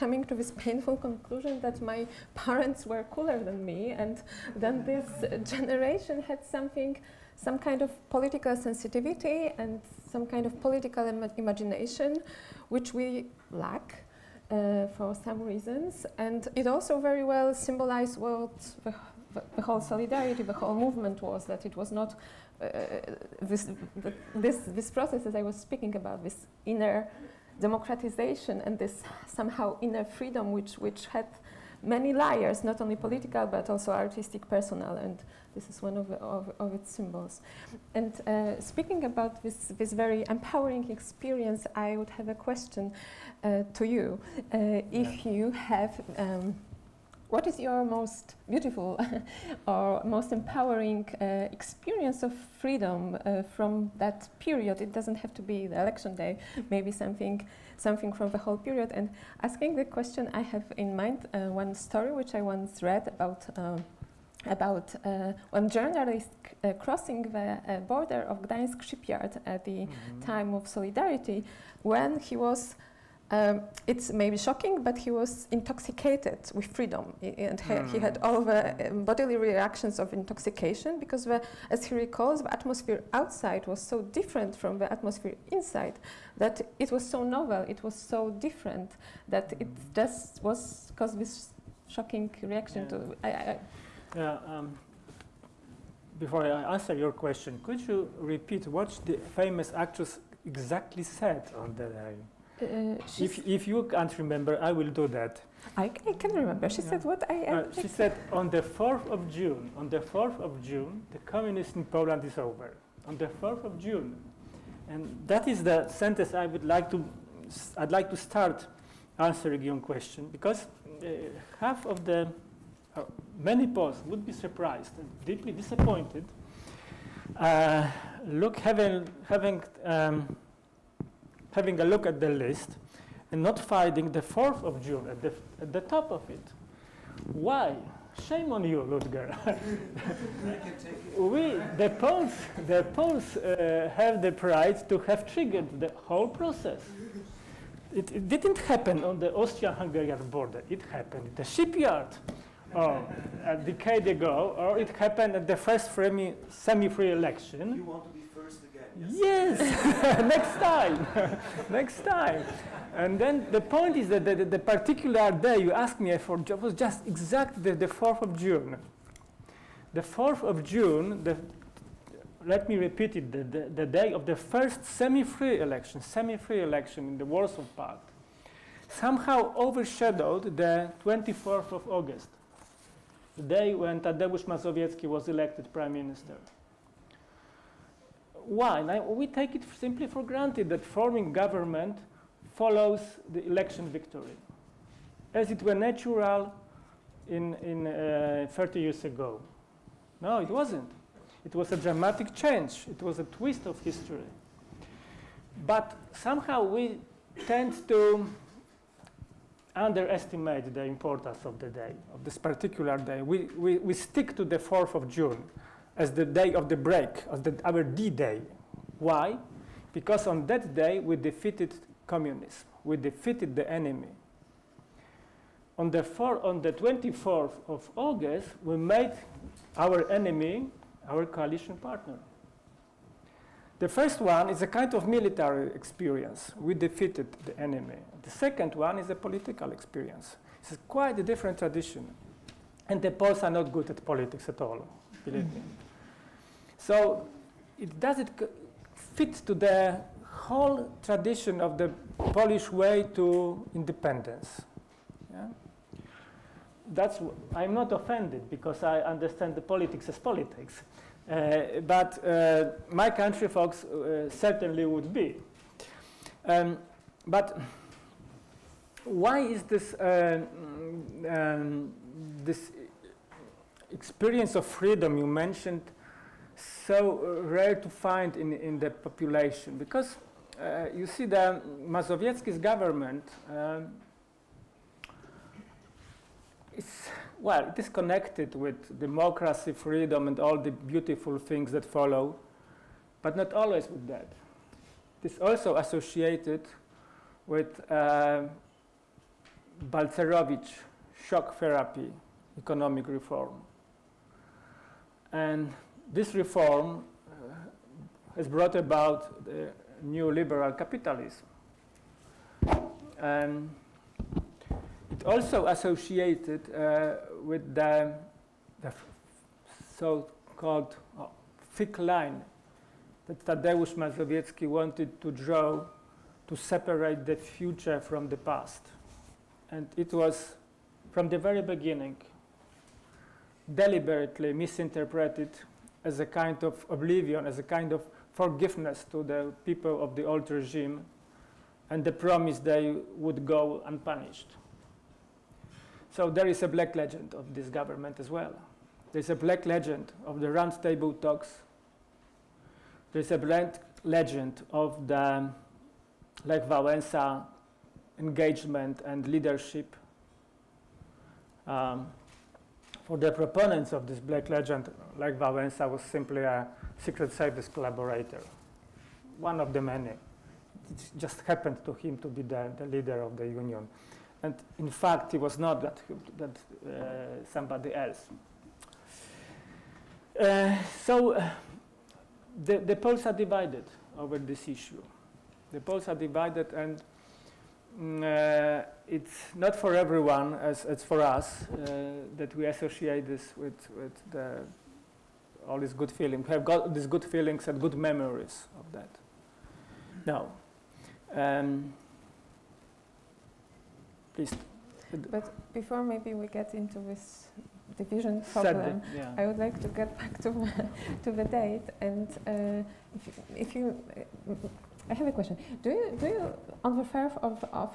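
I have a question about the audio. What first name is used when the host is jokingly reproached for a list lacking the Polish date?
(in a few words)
Ludger.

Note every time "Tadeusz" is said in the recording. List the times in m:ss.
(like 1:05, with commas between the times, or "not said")
3:03, 5:23.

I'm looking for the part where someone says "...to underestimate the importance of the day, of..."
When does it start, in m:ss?
3:27.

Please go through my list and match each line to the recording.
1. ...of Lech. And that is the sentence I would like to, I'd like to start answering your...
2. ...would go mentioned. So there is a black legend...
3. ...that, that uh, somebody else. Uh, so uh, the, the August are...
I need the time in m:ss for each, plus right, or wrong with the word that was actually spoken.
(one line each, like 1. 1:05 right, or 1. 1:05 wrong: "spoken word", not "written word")
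1. 1:53 wrong: "June", not "Lech"
2. 5:43 wrong: "unpunished", not "mentioned"
3. 6:15 wrong: "Poles", not "August".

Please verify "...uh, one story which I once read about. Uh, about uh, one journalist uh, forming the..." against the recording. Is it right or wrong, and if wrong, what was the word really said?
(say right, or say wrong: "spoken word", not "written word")
wrong: "crossing", not "forming".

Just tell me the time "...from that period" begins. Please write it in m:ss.
0:53.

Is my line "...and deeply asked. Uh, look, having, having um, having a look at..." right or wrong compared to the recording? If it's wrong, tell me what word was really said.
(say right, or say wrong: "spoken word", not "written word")
wrong: "disappointed", not "asked".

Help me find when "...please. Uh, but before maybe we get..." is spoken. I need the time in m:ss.
6:44.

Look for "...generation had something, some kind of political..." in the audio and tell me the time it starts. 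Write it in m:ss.
0:05.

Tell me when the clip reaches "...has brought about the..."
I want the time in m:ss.
5:08.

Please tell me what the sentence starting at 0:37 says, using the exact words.
And uh, speaking about this, this very empowering experience, I would have a question uh, to you.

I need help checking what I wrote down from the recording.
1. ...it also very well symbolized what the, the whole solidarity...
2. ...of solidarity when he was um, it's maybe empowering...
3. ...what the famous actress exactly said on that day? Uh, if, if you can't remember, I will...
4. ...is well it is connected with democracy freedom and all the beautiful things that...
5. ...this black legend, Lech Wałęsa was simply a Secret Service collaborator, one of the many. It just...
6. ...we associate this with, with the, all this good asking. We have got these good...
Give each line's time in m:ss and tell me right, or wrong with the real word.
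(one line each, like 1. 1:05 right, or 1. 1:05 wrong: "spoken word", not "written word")
1. 0:16 right
2. 1:10 wrong: "shocking", not "empowering"
3. 1:38 right
4. 4:46 right
5. 6:04 right
6. 6:32 wrong: "feeling", not "asking".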